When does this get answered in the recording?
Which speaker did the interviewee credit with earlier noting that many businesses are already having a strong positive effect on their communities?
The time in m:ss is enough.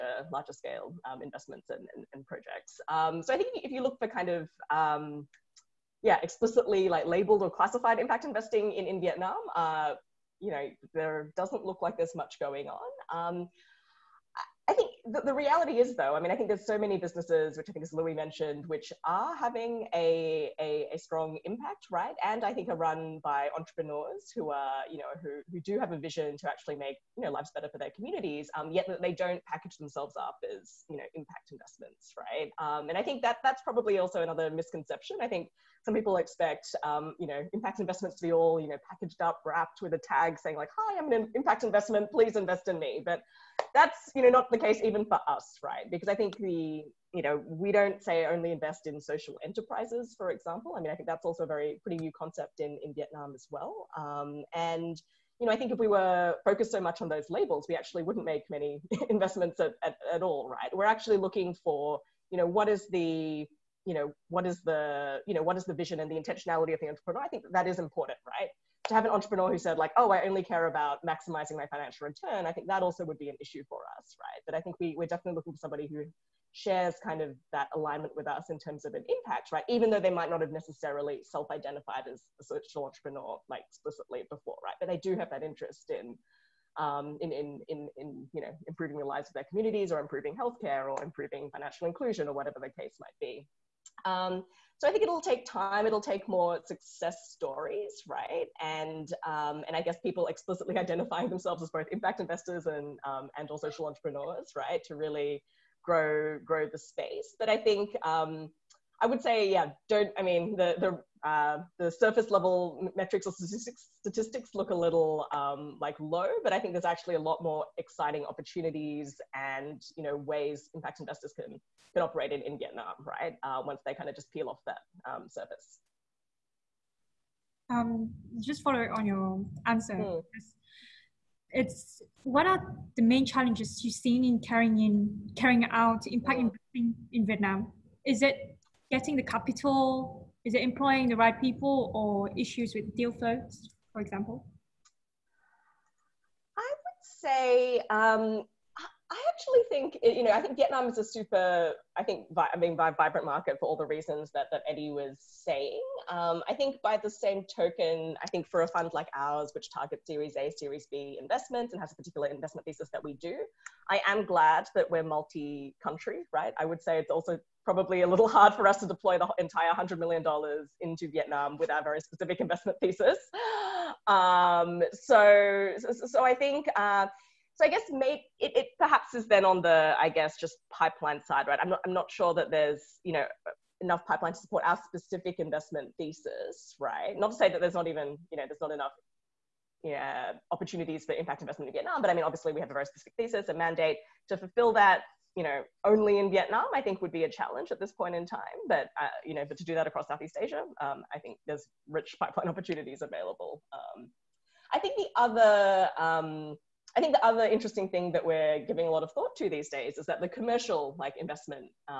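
0:17.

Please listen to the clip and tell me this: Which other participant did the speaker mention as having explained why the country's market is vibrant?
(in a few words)
Eddie.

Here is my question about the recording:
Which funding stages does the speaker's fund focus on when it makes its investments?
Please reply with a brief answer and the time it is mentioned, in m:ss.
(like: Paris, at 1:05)
Series A, Series B, at 2:40.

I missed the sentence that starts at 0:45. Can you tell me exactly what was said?
Because I think the, you know, we don't say only invest in social enterprises, for example.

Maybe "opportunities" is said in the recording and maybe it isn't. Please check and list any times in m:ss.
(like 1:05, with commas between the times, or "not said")
1:58, 3:10, 3:22.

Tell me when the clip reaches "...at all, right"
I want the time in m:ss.
1:00.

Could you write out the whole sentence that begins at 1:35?
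It'll take more success stories, right?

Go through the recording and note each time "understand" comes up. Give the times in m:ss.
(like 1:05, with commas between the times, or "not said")
not said.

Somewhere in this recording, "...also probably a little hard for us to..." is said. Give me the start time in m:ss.
2:47.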